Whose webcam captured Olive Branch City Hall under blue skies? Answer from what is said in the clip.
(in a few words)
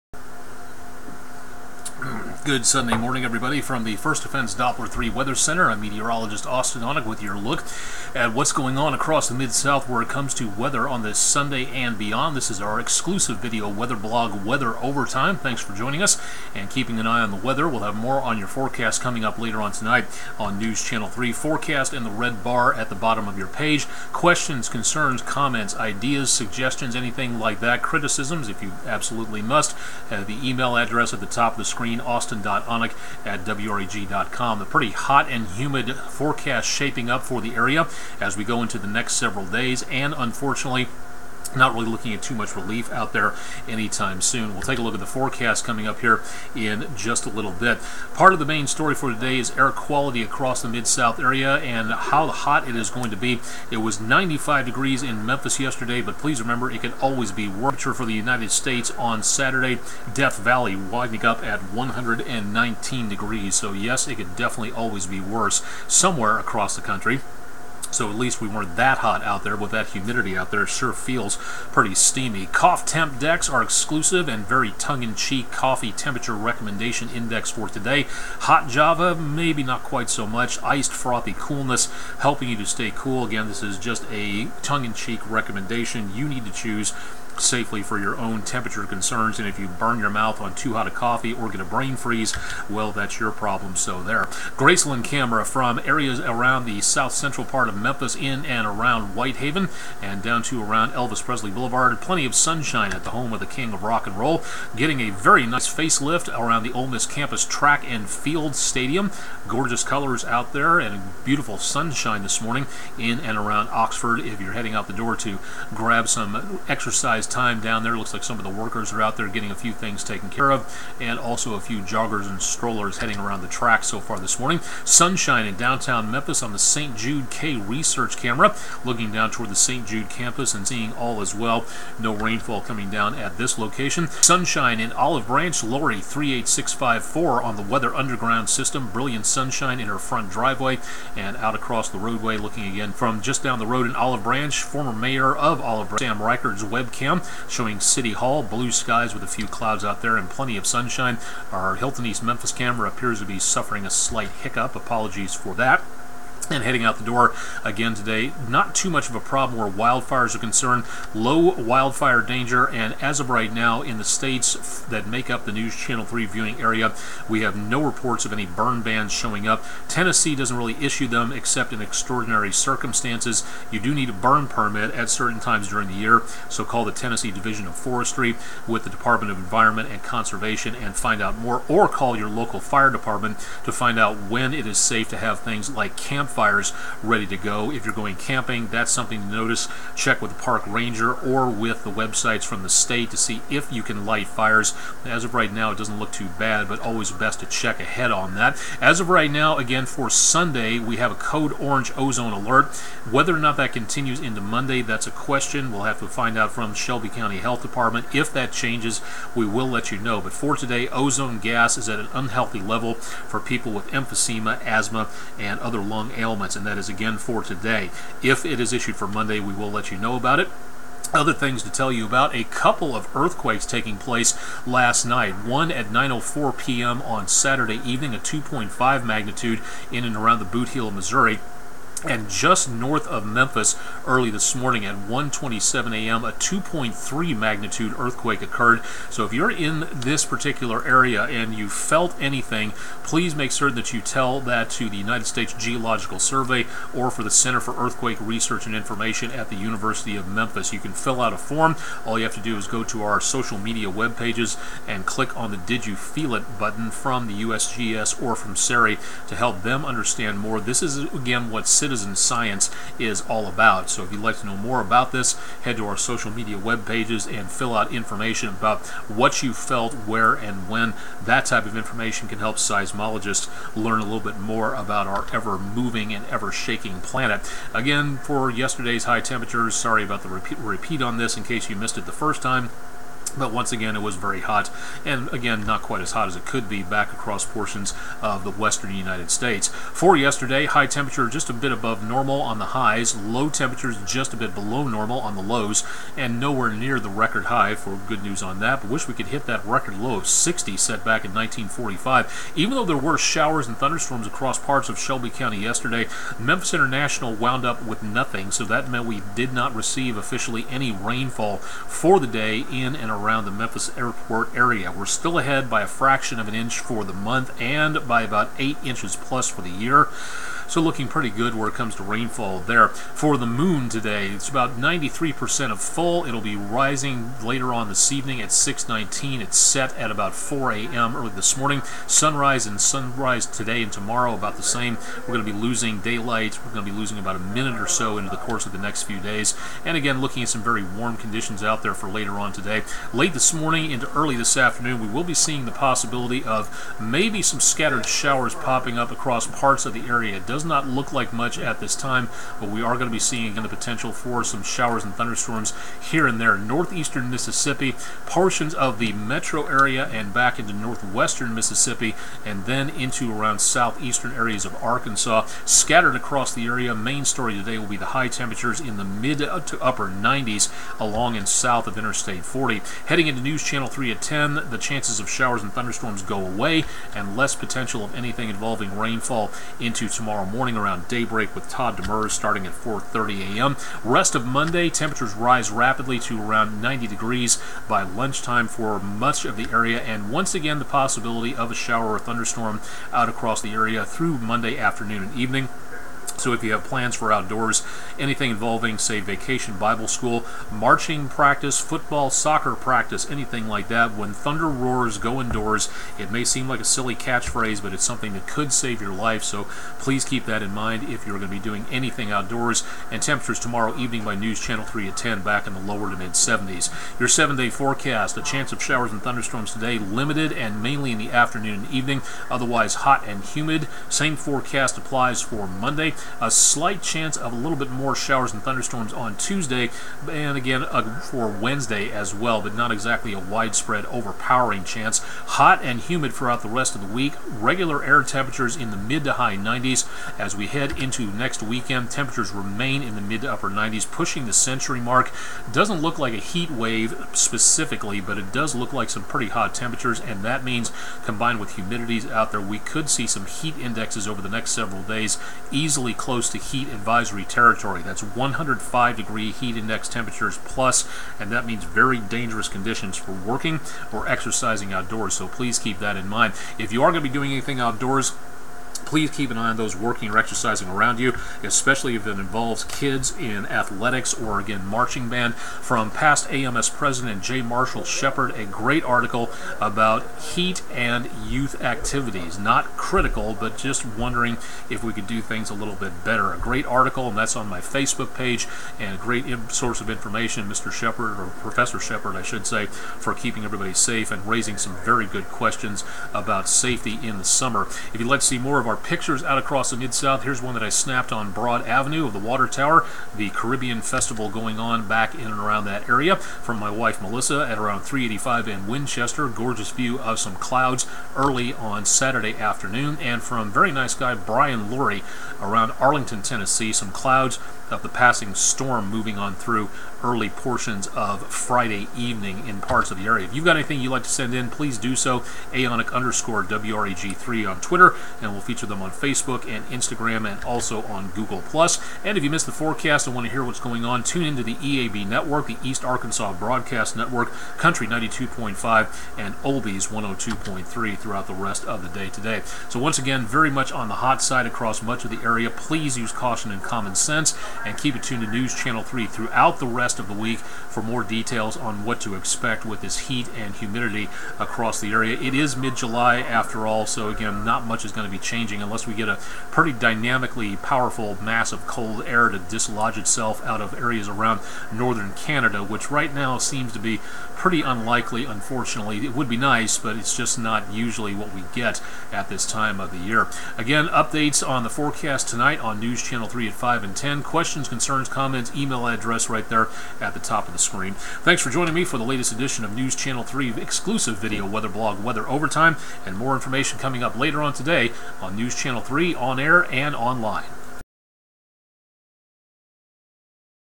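Sam Rikard.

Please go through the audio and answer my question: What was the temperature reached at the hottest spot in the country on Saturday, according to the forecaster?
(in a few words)
119 degrees.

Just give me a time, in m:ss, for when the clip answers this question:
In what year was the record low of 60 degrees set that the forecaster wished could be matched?
5:01.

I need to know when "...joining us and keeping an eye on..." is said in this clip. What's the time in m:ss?
0:15.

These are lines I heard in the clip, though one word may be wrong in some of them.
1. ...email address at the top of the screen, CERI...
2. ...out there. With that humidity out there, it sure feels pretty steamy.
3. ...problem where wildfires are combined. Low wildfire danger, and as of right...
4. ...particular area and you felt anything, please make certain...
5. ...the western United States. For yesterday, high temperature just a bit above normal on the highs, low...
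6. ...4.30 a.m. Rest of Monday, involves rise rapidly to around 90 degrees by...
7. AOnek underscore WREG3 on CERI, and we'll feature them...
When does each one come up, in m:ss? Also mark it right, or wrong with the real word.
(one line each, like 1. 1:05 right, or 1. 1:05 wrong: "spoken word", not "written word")
1. 0:30 wrong: "Austen", not "CERI"
2. 1:09 right
3. 2:39 wrong: "concerned", not "combined"
4. 4:00 right
5. 4:48 right
6. 6:22 wrong: "temperatures", not "involves"
7. 8:45 wrong: "Twitter", not "CERI".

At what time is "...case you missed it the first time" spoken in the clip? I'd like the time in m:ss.
4:41.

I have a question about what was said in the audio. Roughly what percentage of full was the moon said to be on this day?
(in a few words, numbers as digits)
93%.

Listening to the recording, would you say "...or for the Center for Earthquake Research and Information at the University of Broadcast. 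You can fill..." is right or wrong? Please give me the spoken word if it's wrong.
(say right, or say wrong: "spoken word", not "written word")
wrong: "Memphis", not "Broadcast".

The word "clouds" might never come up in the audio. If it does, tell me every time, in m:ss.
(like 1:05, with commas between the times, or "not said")
2:29, 8:30, 8:37.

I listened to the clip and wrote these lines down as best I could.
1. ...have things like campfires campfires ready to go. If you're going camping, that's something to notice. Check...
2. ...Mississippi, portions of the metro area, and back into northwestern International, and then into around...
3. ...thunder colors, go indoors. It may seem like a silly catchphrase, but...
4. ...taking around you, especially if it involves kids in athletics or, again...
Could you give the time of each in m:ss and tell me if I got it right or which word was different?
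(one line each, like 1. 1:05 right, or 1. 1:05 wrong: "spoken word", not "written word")
1. 3:05 right
2. 5:57 wrong: "Mississippi", not "International"
3. 6:44 wrong: "roars", not "colors"
4. 7:50 wrong: "exercising", not "taking".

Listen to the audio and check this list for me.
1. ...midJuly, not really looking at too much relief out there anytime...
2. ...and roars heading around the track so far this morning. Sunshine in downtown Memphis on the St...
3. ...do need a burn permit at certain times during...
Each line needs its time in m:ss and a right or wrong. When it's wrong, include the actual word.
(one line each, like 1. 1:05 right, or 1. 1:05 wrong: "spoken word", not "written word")
1. 0:40 wrong: "unfortunately", not "midJuly"
2. 2:02 wrong: "strollers", not "roars"
3. 2:53 right.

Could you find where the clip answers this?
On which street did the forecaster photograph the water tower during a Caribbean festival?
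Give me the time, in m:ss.
8:21.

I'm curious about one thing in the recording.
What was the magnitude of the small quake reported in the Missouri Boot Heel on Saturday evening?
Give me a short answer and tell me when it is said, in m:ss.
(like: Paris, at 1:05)
2.5, at 3:48.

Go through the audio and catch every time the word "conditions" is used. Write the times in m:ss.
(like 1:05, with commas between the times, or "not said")
5:41, 7:42.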